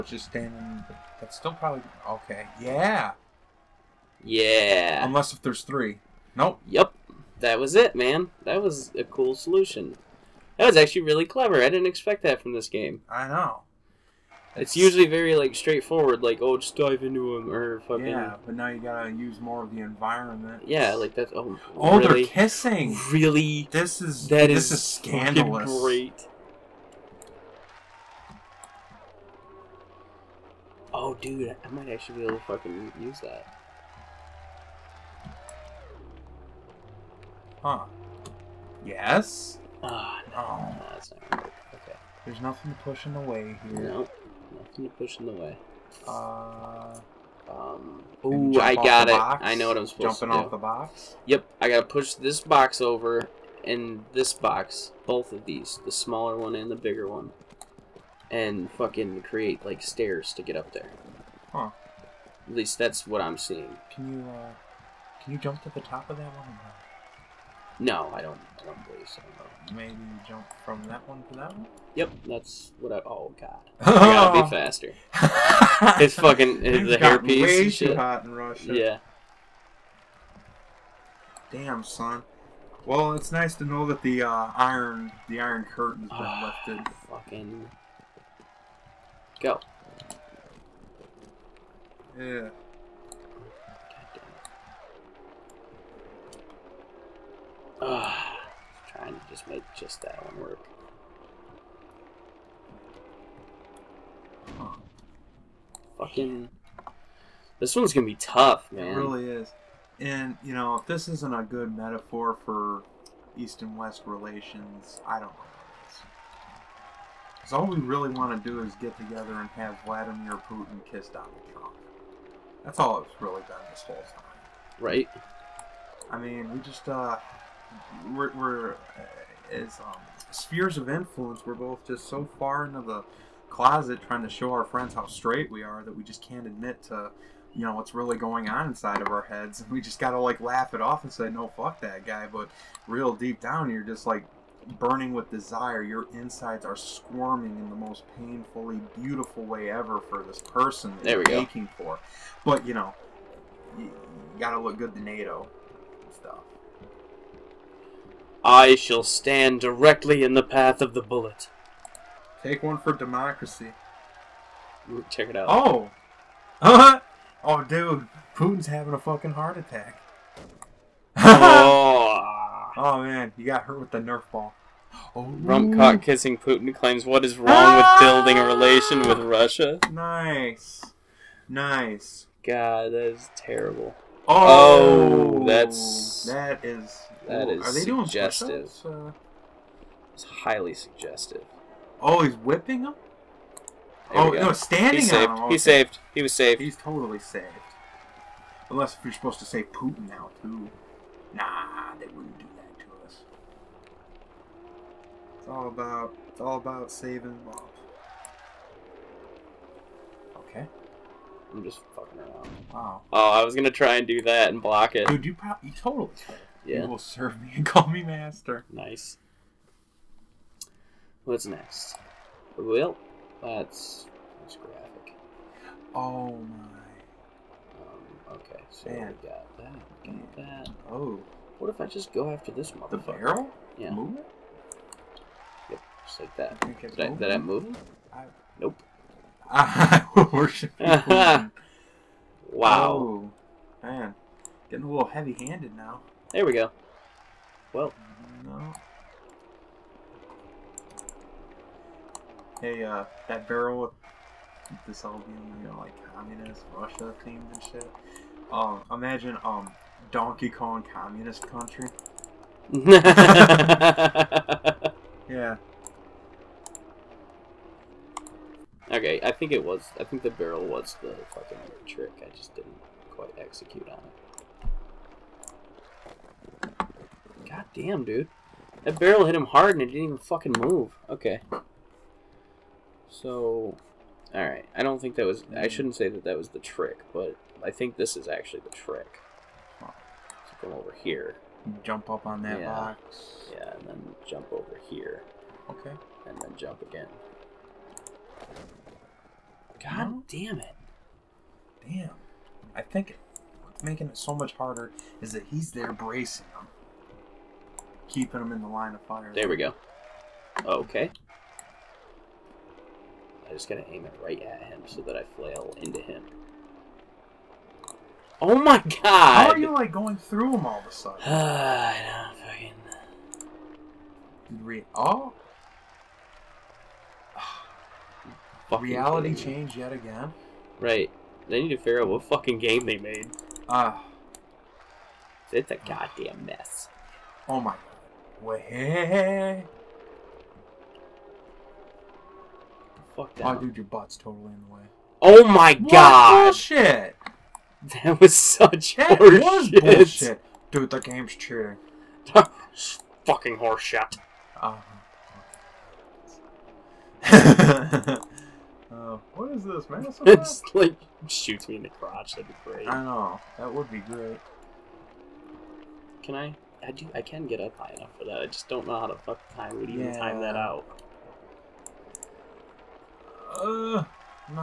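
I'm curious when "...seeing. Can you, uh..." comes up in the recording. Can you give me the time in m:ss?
1:03.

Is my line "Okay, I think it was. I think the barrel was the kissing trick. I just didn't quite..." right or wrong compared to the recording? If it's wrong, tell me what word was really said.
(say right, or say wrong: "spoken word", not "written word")
wrong: "fucking", not "kissing".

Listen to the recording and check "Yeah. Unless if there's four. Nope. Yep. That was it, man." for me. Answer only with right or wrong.
wrong.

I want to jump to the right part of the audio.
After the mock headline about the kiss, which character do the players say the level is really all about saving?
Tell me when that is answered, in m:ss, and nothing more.
3:27.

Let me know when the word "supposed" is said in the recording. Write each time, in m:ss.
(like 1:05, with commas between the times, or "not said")
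0:49, 3:19.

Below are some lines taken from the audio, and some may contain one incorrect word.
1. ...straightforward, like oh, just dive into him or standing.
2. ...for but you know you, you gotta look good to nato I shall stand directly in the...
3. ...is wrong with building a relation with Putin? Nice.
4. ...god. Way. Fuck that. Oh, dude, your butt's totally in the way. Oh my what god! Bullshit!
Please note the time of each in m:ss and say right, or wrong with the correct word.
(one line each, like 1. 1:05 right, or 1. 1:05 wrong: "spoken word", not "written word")
1. 0:15 wrong: "fucking", not "standing"
2. 2:31 right
3. 2:57 wrong: "Russia", not "Putin"
4. 5:37 right.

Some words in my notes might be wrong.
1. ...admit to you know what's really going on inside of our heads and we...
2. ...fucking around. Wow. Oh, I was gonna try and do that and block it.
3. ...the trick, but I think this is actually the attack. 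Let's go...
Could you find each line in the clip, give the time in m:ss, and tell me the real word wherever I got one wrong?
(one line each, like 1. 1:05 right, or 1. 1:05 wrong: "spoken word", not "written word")
1. 2:16 right
2. 3:31 right
3. 4:46 wrong: "trick", not "attack".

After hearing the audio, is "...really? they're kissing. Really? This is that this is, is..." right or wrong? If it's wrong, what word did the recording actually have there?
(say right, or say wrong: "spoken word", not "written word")
right.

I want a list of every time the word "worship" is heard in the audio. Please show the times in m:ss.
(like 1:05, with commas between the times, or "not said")
4:00.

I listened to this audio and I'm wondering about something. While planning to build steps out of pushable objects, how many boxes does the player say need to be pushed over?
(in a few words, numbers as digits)
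2.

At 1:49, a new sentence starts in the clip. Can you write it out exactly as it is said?
And, you know, this isn't a good metaphor for East and West relations, I don't know.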